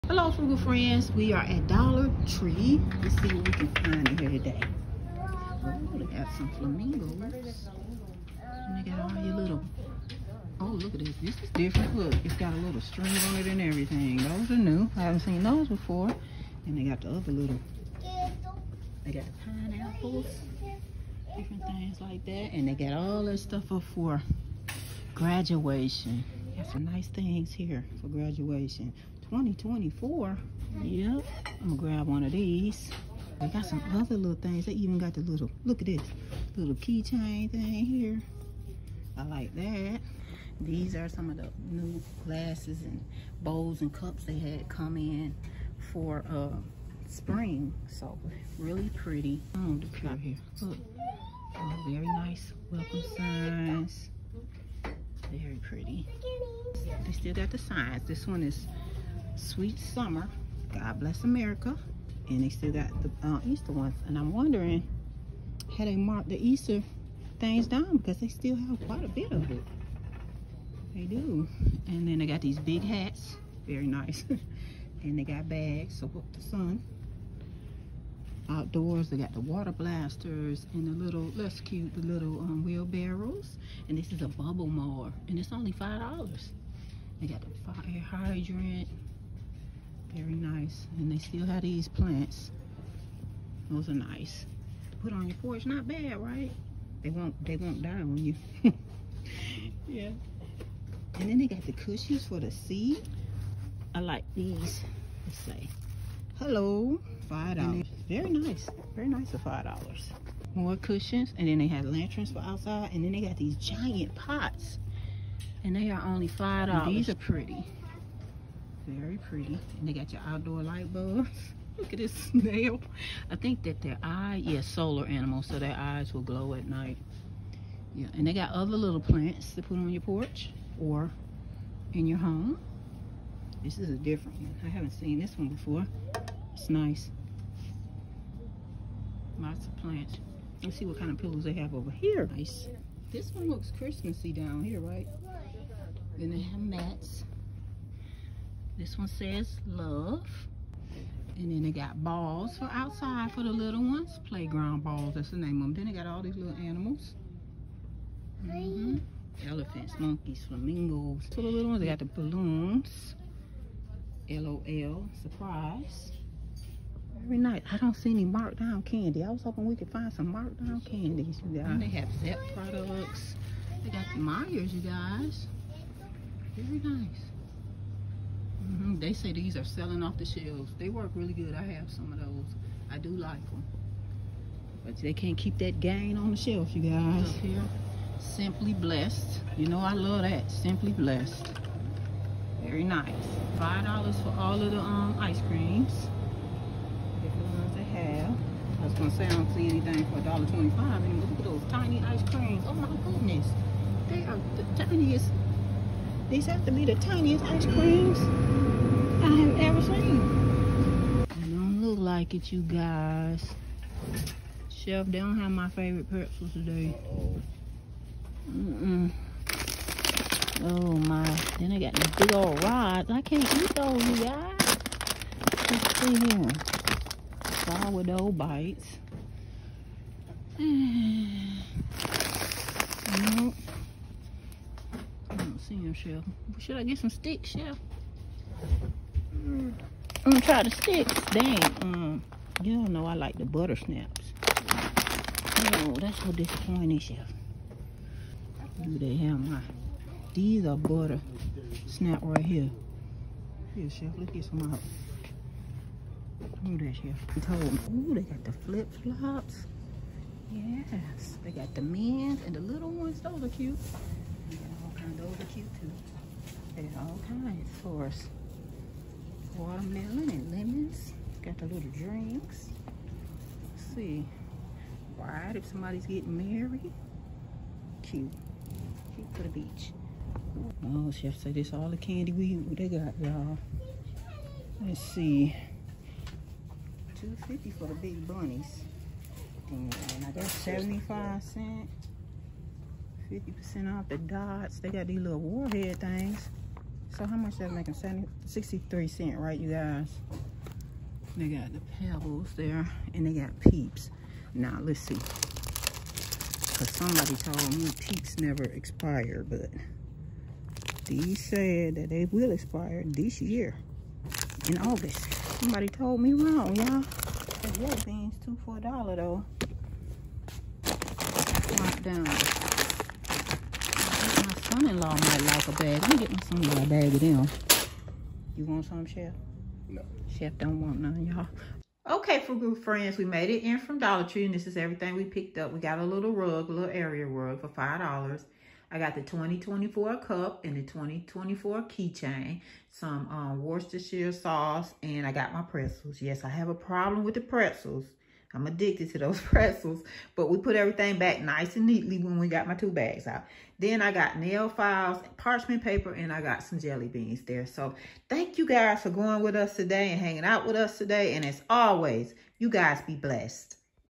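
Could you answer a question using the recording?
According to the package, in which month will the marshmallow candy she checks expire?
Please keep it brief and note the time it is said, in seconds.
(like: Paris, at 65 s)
August, at 314 s.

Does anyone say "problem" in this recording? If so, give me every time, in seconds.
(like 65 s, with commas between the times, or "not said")
346 s.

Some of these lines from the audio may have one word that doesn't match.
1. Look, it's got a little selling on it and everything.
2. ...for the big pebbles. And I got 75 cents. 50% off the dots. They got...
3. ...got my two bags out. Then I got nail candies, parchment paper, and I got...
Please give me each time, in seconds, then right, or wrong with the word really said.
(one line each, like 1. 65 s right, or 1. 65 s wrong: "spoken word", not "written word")
1. 11 s wrong: "string", not "selling"
2. 287 s wrong: "bunnies", not "pebbles"
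3. 352 s wrong: "files", not "candies".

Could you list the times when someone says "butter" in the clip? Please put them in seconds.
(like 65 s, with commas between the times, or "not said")
243 s, 250 s.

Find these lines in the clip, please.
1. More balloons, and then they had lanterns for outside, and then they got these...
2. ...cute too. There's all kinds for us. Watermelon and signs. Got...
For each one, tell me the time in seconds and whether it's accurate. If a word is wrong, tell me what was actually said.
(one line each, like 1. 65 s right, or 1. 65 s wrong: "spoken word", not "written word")
1. 110 s wrong: "cushions", not "balloons"
2. 265 s wrong: "lemons", not "signs".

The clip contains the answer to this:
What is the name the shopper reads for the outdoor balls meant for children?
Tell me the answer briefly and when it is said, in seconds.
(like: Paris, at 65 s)
Playground balls, at 154 s.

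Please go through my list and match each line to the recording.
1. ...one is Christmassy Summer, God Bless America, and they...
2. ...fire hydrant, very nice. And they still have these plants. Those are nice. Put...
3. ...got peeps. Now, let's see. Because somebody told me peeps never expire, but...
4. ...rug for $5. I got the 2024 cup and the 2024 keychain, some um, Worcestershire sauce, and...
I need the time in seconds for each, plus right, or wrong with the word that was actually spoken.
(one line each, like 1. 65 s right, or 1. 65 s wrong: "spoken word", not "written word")
1. 58 s wrong: "Sweet", not "Christmassy"
2. 87 s right
3. 303 s right
4. 337 s right.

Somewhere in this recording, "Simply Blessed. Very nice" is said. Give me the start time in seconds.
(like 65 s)
190 s.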